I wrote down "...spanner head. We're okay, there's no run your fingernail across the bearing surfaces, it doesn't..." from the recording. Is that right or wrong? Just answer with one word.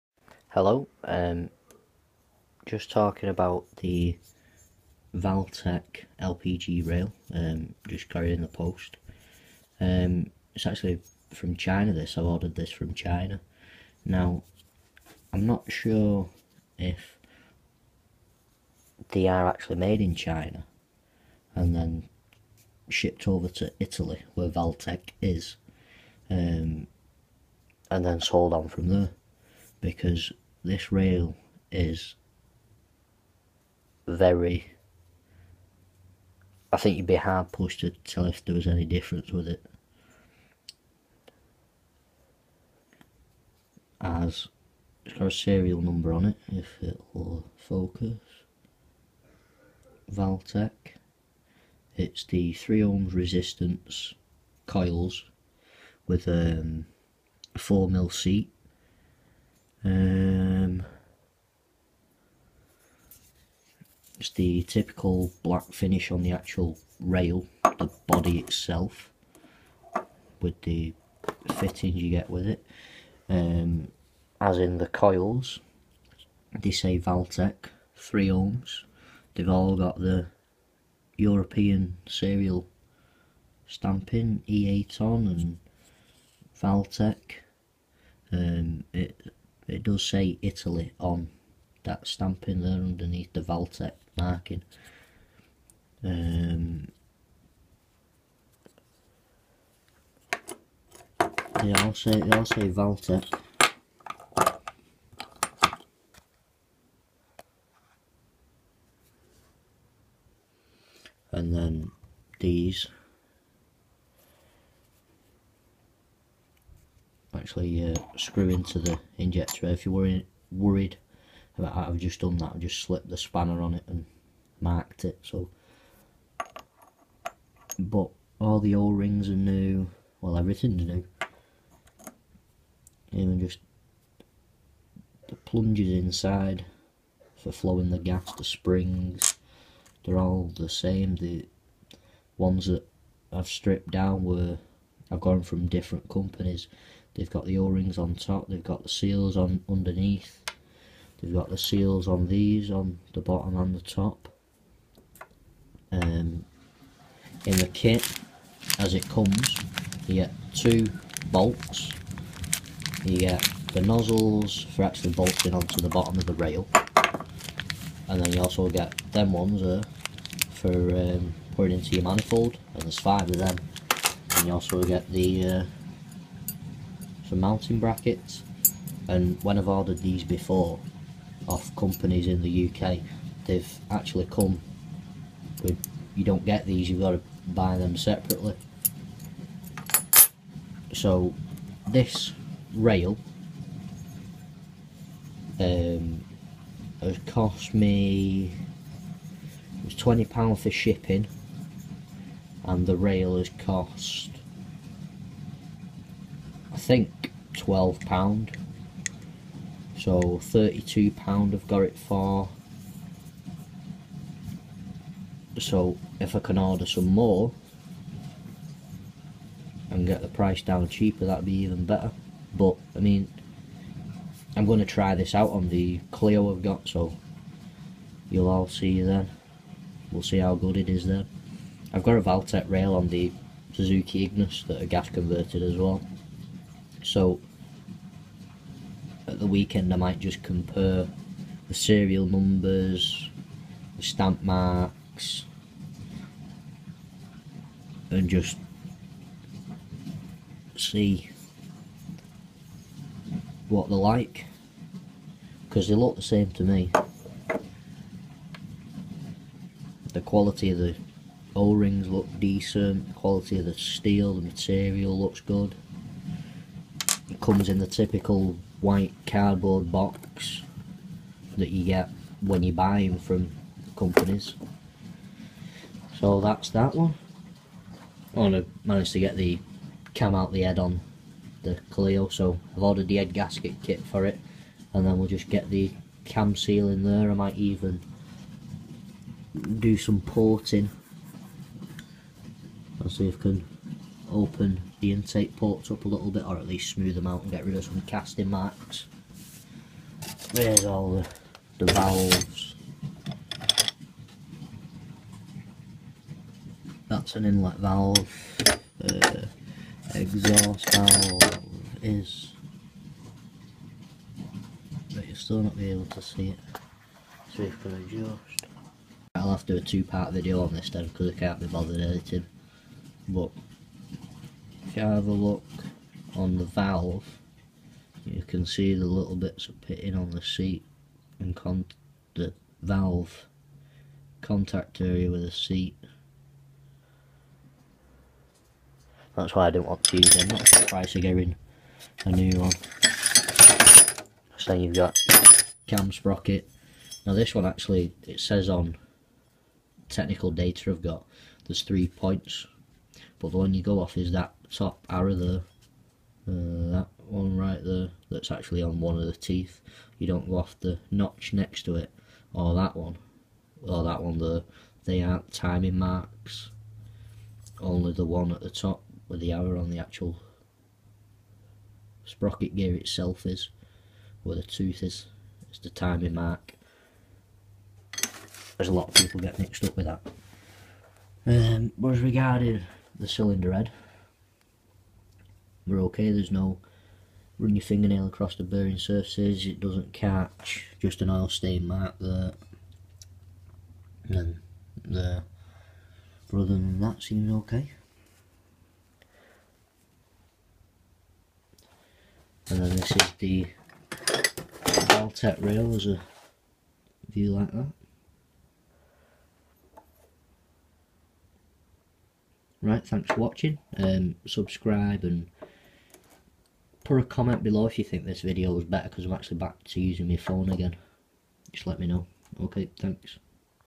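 wrong.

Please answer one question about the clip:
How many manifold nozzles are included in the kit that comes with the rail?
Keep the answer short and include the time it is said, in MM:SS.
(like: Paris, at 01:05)
5, at 02:52.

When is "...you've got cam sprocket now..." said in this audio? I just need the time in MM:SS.
05:44.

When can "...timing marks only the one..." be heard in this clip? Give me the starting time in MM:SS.
06:05.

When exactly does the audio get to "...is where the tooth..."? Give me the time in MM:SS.
06:13.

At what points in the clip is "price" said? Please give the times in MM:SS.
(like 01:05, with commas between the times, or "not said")
03:40, 05:40.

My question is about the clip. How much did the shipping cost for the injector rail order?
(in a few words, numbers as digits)
£20.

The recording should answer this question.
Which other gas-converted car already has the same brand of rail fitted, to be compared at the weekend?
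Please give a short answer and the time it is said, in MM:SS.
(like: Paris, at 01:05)
Suzuki Ignis, at 03:53.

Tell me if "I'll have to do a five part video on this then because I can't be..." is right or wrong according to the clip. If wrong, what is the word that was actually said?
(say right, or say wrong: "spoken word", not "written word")
wrong: "two", not "five".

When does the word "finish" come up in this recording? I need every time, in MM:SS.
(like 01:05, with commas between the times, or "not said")
01:05.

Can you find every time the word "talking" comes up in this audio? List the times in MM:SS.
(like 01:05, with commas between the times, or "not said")
00:02.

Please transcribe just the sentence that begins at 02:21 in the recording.
The ones that I've stripped down were I've gone from different companies.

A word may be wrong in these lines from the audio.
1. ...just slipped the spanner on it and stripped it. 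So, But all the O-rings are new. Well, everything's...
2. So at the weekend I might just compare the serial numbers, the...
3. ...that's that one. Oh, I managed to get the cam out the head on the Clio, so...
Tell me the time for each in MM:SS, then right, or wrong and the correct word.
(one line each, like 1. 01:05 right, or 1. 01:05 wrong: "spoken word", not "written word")
1. 02:02 wrong: "marked", not "stripped"
2. 03:57 right
3. 04:36 right.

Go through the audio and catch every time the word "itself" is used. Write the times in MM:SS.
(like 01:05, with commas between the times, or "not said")
01:08, 06:12.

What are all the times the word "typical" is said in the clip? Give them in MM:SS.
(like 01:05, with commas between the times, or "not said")
01:04, 04:27.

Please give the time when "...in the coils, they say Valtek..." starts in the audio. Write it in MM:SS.
01:14.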